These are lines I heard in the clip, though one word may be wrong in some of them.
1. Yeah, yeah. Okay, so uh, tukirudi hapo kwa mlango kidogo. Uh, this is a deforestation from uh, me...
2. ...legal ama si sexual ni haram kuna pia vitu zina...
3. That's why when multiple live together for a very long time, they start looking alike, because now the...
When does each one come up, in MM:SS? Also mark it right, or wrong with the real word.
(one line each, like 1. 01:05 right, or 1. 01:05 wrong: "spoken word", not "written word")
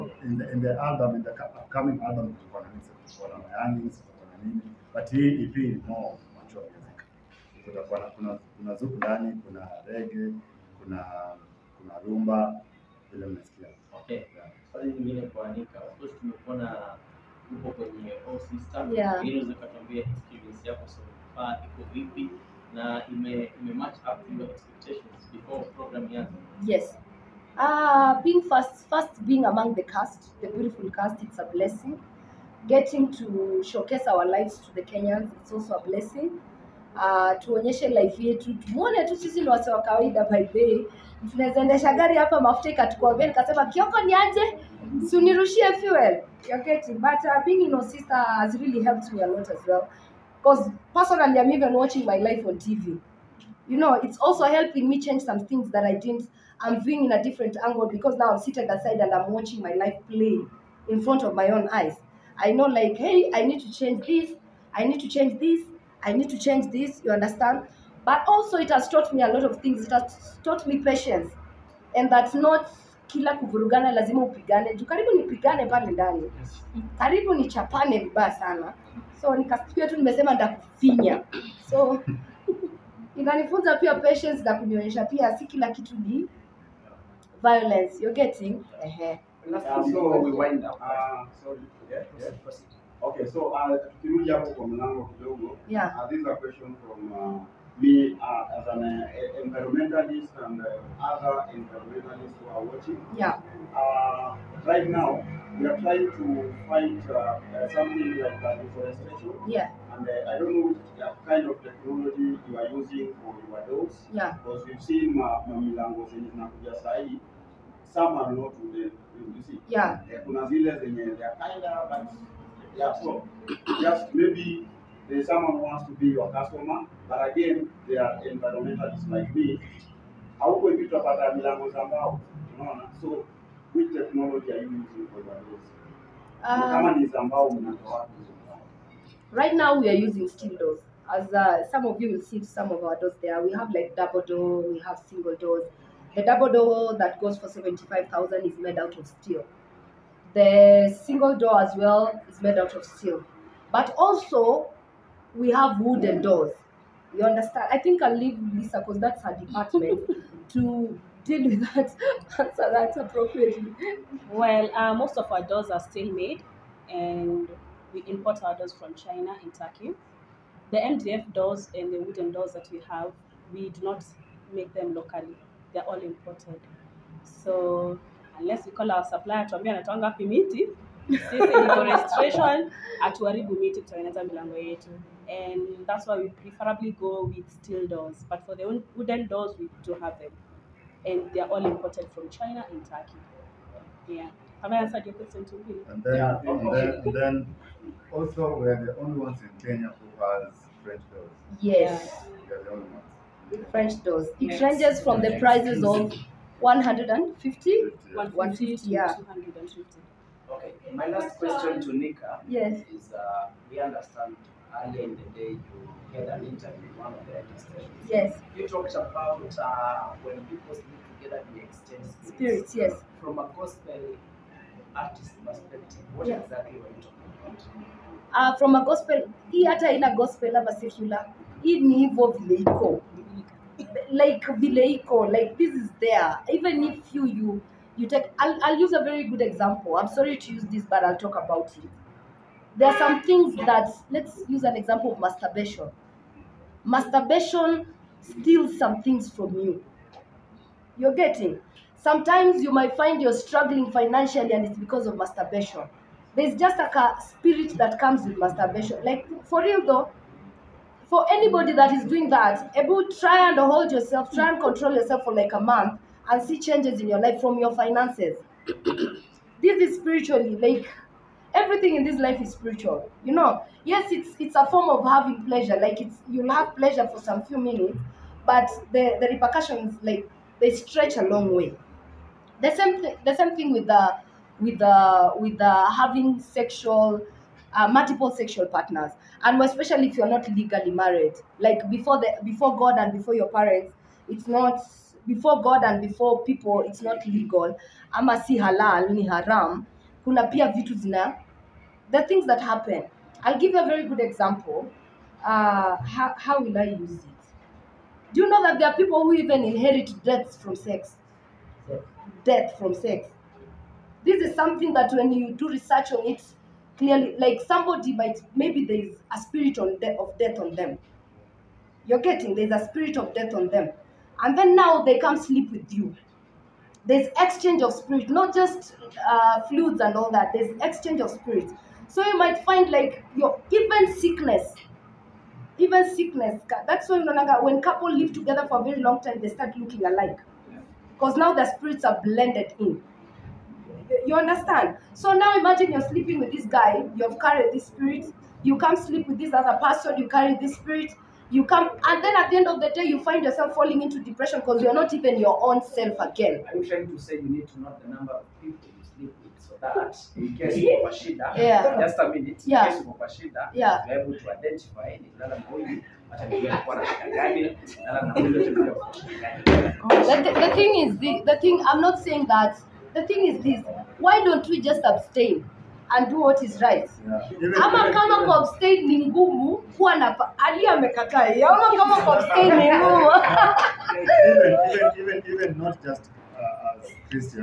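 1. 01:31 wrong: "question", not "deforestation"
2. 04:57 wrong: "halal", not "sexual"
3. 05:36 wrong: "couple", not "multiple".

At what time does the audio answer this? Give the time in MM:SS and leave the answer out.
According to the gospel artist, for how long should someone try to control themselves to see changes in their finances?
04:25.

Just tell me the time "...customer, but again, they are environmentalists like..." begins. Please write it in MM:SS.
02:06.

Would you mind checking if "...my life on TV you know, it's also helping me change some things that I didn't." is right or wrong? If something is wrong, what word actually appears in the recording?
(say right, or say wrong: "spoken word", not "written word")
right.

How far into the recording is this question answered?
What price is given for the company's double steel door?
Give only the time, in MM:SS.
02:27.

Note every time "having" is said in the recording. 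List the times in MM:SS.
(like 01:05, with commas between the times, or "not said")
04:35, 04:45.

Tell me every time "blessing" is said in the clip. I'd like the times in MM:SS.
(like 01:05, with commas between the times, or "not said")
00:31, 00:35.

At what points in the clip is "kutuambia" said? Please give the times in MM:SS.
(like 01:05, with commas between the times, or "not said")
00:19.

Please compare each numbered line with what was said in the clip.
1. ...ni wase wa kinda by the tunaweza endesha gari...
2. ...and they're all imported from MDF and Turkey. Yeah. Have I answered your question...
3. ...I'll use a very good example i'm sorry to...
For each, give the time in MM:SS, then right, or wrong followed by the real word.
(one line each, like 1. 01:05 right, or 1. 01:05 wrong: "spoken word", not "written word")
1. 00:39 wrong: "kawaida", not "kinda"
2. 03:11 wrong: "China", not "MDF"
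3. 03:58 right.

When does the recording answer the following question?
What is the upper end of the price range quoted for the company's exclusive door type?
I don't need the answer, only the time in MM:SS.
03:28.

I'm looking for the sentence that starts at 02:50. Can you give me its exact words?
The MDF doors and the wooden doors that we have, we do not make them locally.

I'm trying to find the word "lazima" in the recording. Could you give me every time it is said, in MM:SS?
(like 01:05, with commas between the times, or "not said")
01:13.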